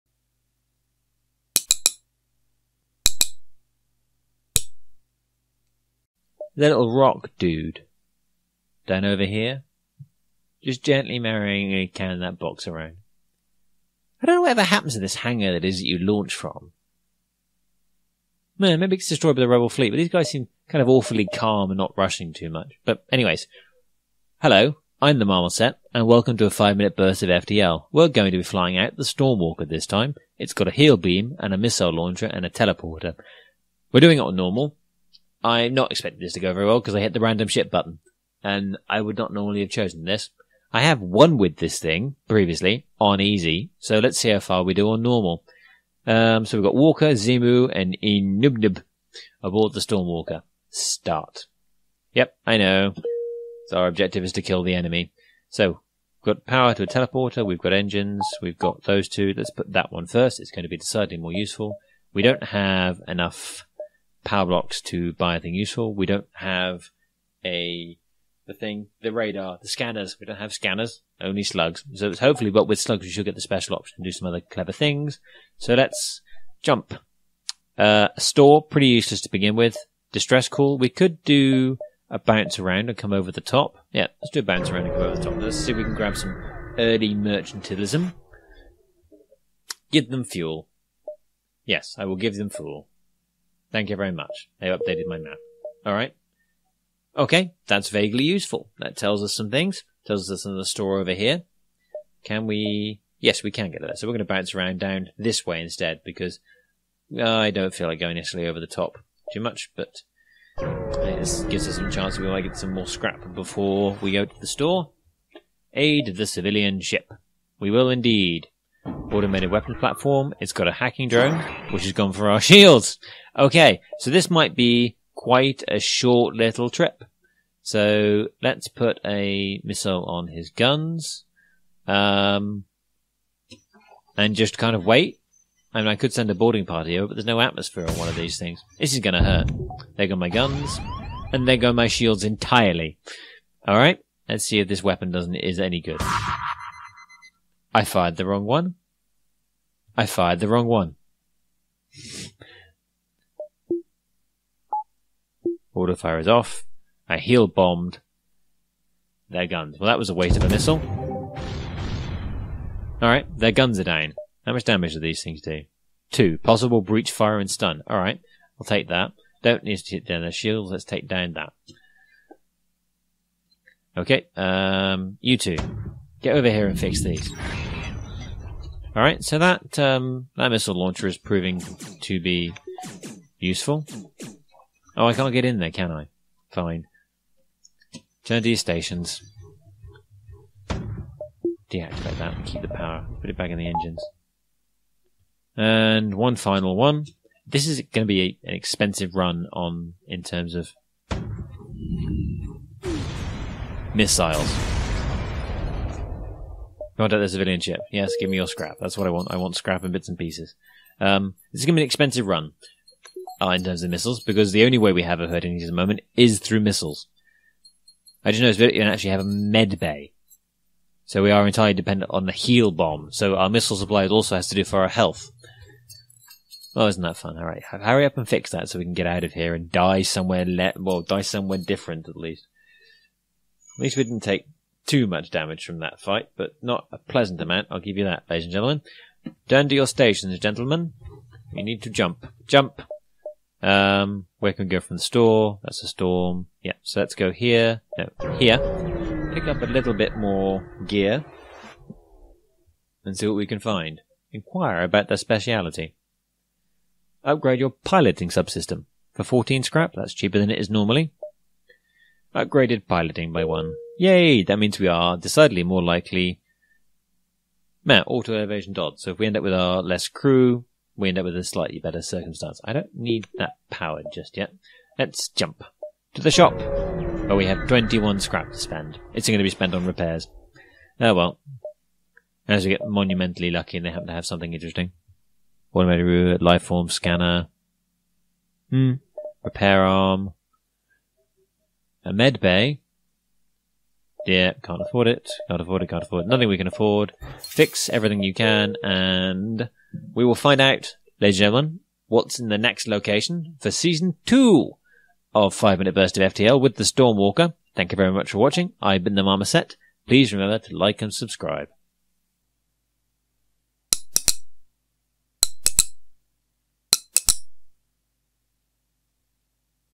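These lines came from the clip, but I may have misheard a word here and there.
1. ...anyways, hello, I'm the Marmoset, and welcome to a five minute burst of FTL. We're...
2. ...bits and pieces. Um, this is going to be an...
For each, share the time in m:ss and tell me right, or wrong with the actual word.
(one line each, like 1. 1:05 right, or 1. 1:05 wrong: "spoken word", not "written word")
1. 0:23 right
2. 3:29 right.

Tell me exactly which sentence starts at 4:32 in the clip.
I don't need that power just yet.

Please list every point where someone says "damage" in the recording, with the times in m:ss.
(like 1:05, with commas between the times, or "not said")
2:44, 3:55.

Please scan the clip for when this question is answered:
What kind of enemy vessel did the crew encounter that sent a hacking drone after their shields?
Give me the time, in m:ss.
1:58.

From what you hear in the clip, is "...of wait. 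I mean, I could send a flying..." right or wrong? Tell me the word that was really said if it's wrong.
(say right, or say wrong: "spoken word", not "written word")
wrong: "boarding", not "flying".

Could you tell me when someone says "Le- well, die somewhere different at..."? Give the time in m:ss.
3:50.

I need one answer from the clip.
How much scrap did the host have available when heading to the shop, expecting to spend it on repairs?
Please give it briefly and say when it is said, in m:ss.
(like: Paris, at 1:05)
21, at 4:37.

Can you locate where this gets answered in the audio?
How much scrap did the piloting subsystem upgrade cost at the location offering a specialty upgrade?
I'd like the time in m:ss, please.
4:19.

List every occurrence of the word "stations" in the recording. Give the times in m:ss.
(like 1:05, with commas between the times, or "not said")
3:08, 3:59.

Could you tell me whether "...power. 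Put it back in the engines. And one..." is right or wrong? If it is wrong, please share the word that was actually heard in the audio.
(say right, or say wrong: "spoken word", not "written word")
right.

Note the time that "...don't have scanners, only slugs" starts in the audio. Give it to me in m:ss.
1:10.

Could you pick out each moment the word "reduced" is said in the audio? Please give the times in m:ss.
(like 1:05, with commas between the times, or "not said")
not said.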